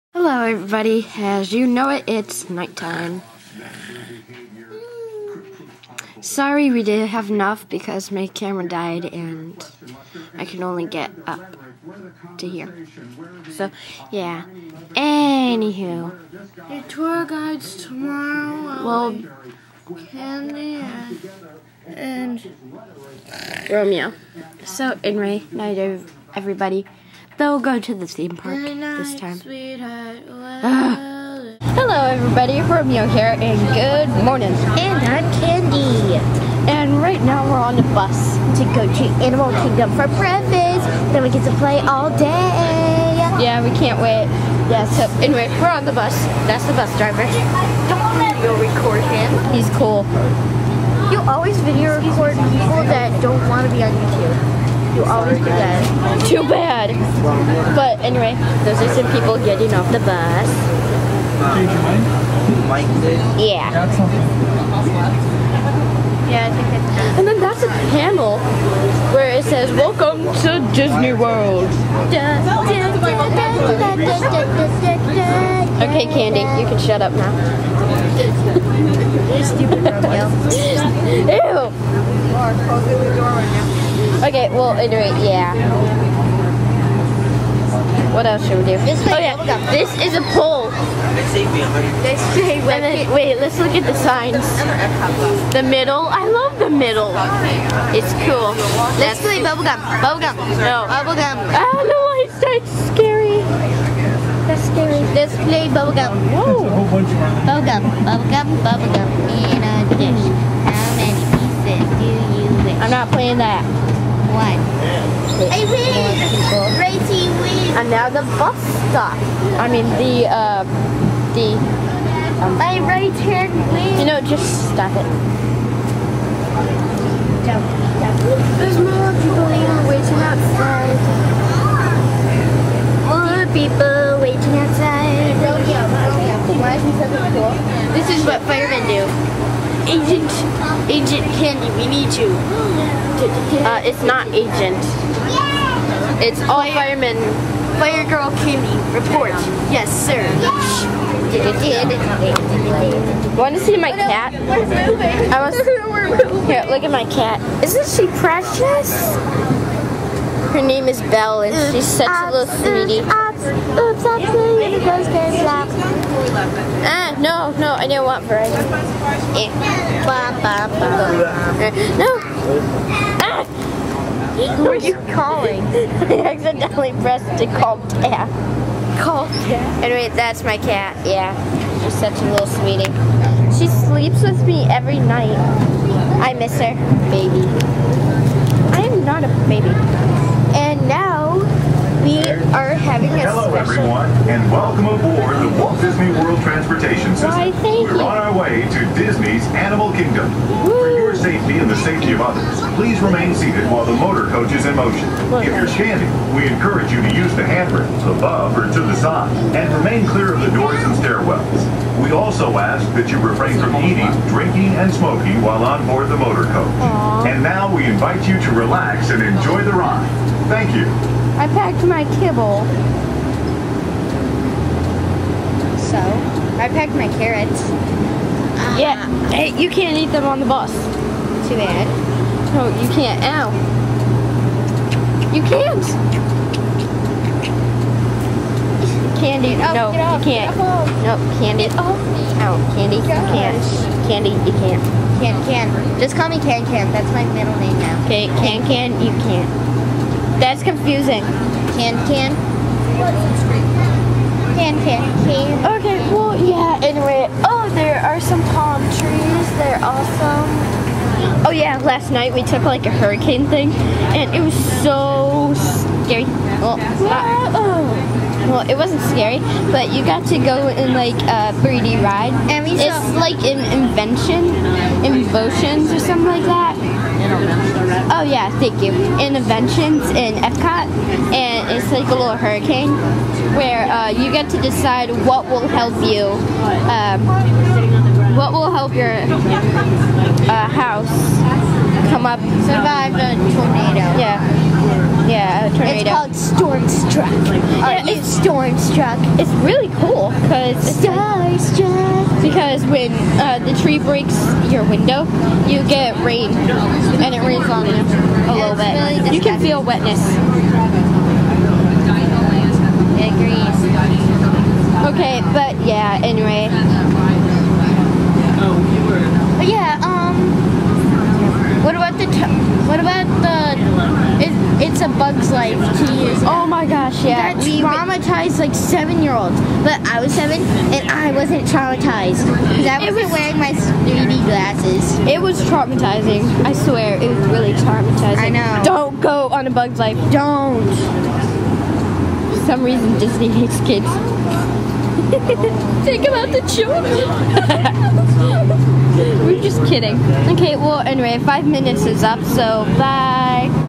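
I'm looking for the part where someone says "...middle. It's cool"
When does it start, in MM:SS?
01:36.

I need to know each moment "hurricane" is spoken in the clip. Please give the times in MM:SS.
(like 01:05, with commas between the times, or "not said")
04:22, 04:42.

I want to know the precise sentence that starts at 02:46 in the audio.
Ah, no, no, I didn't want Verizon.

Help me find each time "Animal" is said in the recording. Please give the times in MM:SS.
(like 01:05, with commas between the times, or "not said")
00:39, 03:19.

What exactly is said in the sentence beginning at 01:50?
How many pieces do you wish?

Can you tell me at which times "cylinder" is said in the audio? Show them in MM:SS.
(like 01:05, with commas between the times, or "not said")
not said.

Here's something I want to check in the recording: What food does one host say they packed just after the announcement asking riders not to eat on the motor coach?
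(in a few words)
carrots.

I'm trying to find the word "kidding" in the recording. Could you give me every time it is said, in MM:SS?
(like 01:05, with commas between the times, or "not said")
05:49.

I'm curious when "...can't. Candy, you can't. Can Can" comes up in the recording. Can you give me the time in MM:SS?
04:03.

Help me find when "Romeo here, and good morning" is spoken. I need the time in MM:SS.
00:32.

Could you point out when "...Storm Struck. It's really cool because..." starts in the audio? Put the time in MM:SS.
04:58.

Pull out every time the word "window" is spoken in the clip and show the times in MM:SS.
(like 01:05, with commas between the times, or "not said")
05:04.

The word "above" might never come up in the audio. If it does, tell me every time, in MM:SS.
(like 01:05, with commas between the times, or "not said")
03:28.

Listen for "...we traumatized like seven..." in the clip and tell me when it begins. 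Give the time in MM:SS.
05:27.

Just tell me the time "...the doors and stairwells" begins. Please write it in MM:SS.
03:30.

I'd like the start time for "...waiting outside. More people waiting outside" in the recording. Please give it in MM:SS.
02:09.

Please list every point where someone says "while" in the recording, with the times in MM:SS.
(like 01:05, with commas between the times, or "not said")
03:23, 03:35.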